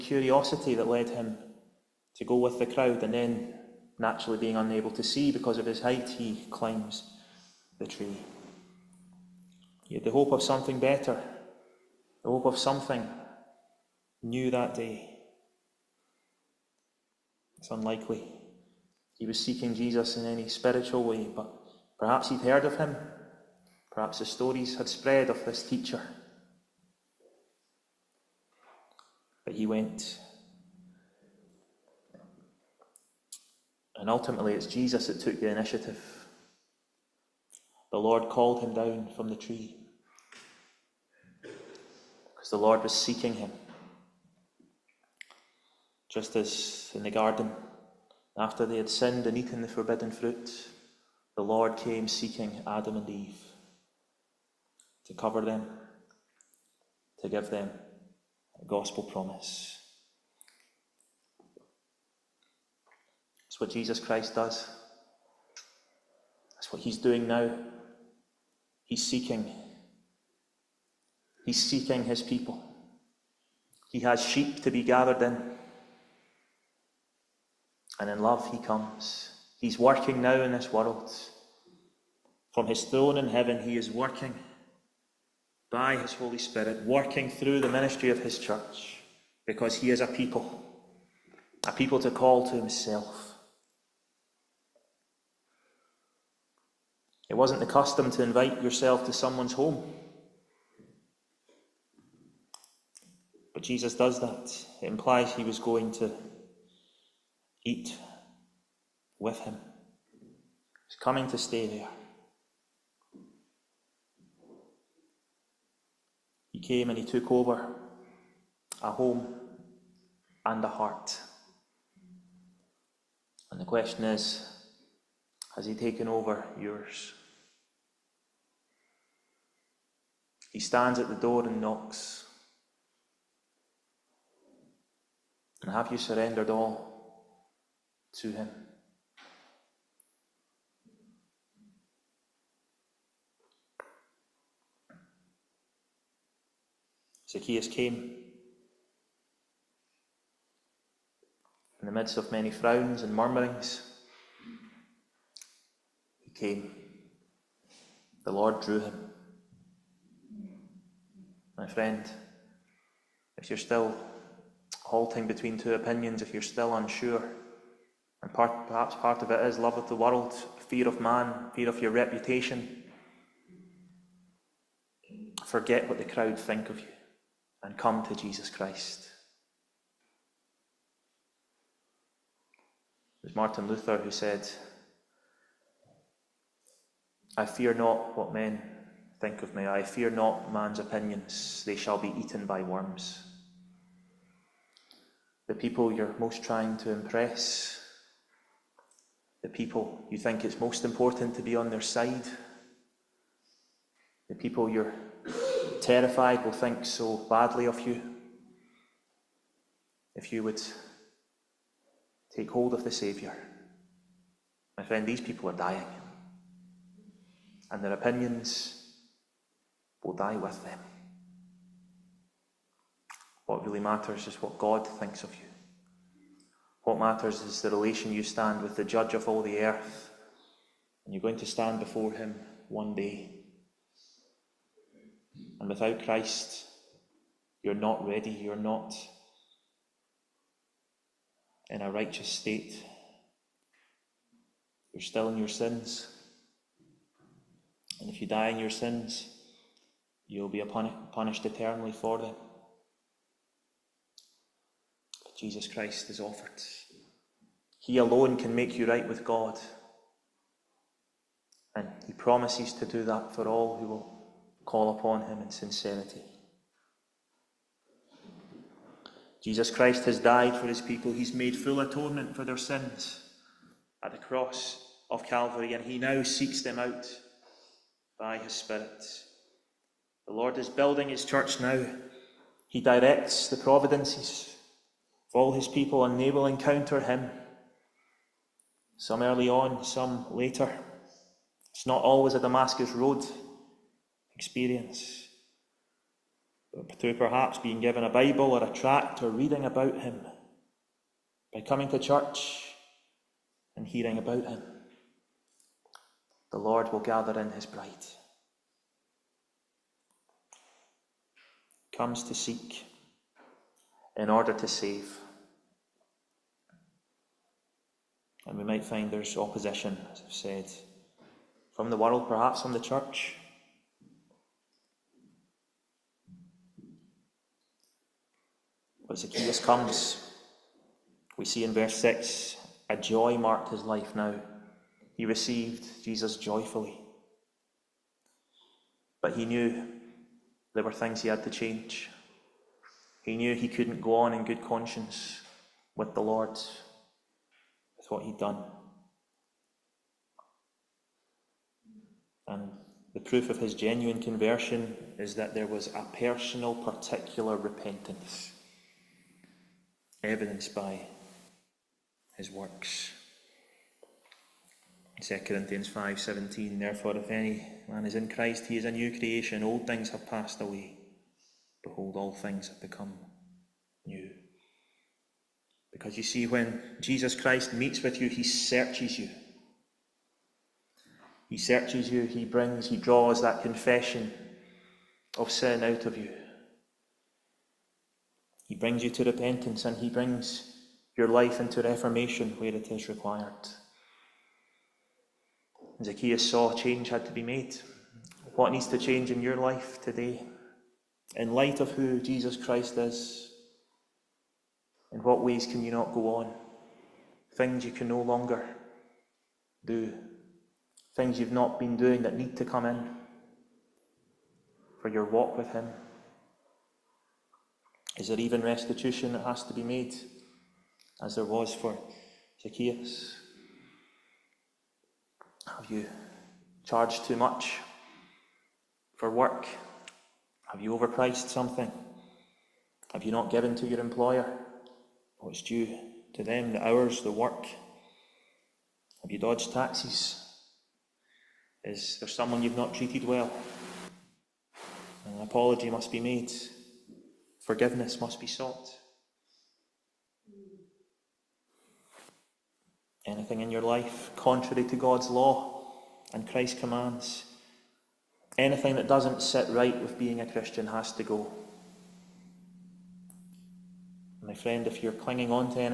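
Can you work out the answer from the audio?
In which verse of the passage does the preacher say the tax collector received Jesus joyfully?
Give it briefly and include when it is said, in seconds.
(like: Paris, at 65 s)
Verse 6, at 331 s.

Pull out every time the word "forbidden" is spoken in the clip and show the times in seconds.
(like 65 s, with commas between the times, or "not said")
49 s.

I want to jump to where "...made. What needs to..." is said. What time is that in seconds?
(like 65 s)
397 s.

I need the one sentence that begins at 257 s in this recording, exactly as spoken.
He alone can make you right with God.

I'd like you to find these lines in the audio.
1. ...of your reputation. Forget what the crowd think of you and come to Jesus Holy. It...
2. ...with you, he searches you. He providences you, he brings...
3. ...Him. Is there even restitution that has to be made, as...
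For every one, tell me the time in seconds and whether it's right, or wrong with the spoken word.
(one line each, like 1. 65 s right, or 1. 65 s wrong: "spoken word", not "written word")
1. 171 s wrong: "Christ", not "Holy"
2. 378 s wrong: "searches", not "providences"
3. 415 s right.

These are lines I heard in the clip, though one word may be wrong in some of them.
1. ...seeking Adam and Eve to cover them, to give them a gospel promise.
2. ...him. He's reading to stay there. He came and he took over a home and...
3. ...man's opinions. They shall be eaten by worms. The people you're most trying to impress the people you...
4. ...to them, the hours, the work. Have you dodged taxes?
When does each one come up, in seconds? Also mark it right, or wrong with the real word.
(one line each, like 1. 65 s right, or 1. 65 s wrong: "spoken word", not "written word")
1. 52 s right
2. 109 s wrong: "coming", not "reading"
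3. 190 s right
4. 436 s right.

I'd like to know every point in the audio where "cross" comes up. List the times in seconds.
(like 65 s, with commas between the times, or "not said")
274 s.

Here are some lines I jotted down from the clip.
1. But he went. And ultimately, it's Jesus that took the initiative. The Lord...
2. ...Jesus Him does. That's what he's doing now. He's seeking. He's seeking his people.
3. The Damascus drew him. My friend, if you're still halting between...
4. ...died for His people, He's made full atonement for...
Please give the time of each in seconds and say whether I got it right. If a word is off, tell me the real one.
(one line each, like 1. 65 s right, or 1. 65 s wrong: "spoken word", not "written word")
1. 29 s right
2. 63 s wrong: "Christ", not "Him"
3. 158 s wrong: "Lord", not "Damascus"
4. 270 s right.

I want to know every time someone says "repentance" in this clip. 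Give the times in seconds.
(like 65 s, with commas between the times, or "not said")
357 s, 389 s.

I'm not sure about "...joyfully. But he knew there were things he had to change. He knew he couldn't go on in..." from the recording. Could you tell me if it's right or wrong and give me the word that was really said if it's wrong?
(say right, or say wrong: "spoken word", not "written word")
right.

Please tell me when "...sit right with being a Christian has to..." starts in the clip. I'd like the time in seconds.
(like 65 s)
459 s.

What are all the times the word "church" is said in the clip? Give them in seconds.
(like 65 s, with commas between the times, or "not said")
88 s, 281 s, 301 s, 322 s.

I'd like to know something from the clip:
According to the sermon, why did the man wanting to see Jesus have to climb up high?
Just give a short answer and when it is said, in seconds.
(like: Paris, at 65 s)
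His height, at 5 s.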